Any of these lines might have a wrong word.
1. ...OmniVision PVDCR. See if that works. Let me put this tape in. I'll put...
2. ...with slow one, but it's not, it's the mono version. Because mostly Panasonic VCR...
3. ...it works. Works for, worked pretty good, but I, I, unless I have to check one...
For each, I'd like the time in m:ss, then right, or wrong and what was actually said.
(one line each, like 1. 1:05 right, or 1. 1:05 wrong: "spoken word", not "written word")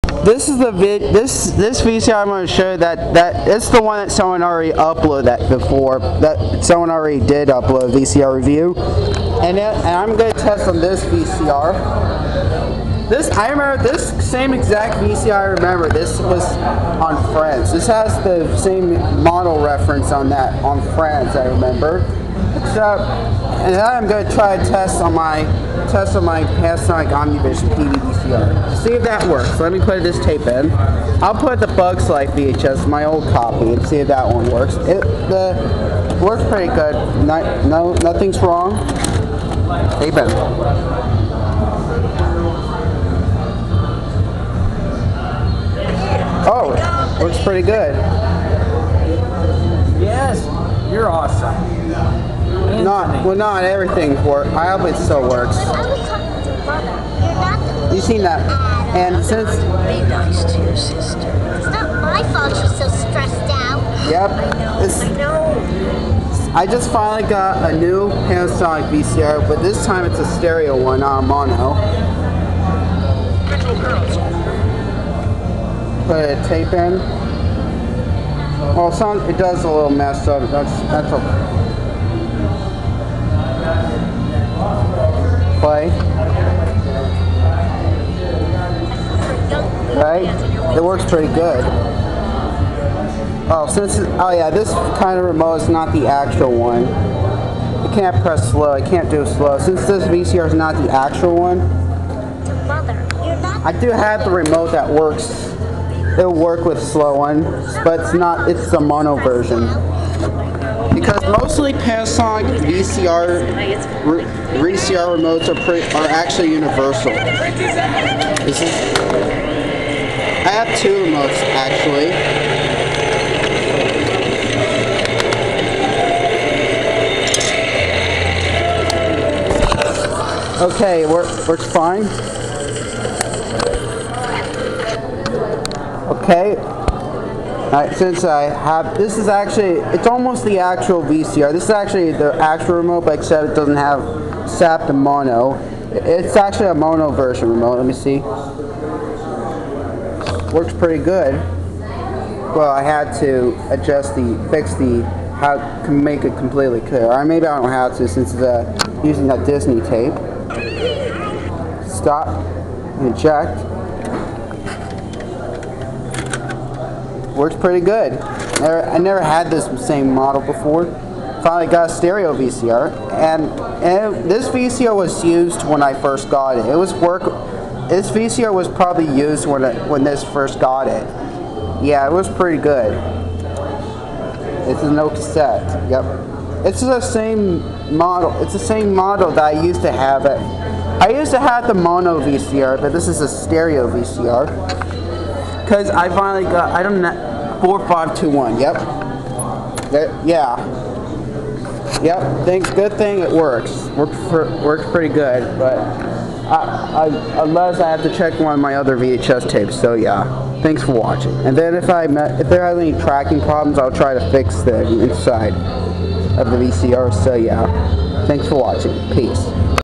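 1. 0:27 right
2. 1:46 right
3. 3:23 right.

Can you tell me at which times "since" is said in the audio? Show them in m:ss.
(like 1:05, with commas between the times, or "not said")
0:59, 1:33, 1:39, 2:17, 2:38.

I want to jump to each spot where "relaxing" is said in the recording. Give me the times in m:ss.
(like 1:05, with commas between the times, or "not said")
not said.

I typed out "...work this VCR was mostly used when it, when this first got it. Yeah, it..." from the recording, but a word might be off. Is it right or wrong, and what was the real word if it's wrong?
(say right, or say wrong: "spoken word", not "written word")
wrong: "probably", not "mostly".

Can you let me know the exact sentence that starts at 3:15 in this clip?
Cause I finally got I don't know four five two one.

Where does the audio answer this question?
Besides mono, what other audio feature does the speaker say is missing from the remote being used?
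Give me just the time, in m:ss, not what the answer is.
2:24.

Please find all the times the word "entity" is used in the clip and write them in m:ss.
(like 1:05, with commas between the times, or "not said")
not said.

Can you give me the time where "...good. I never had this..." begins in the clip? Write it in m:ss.
2:47.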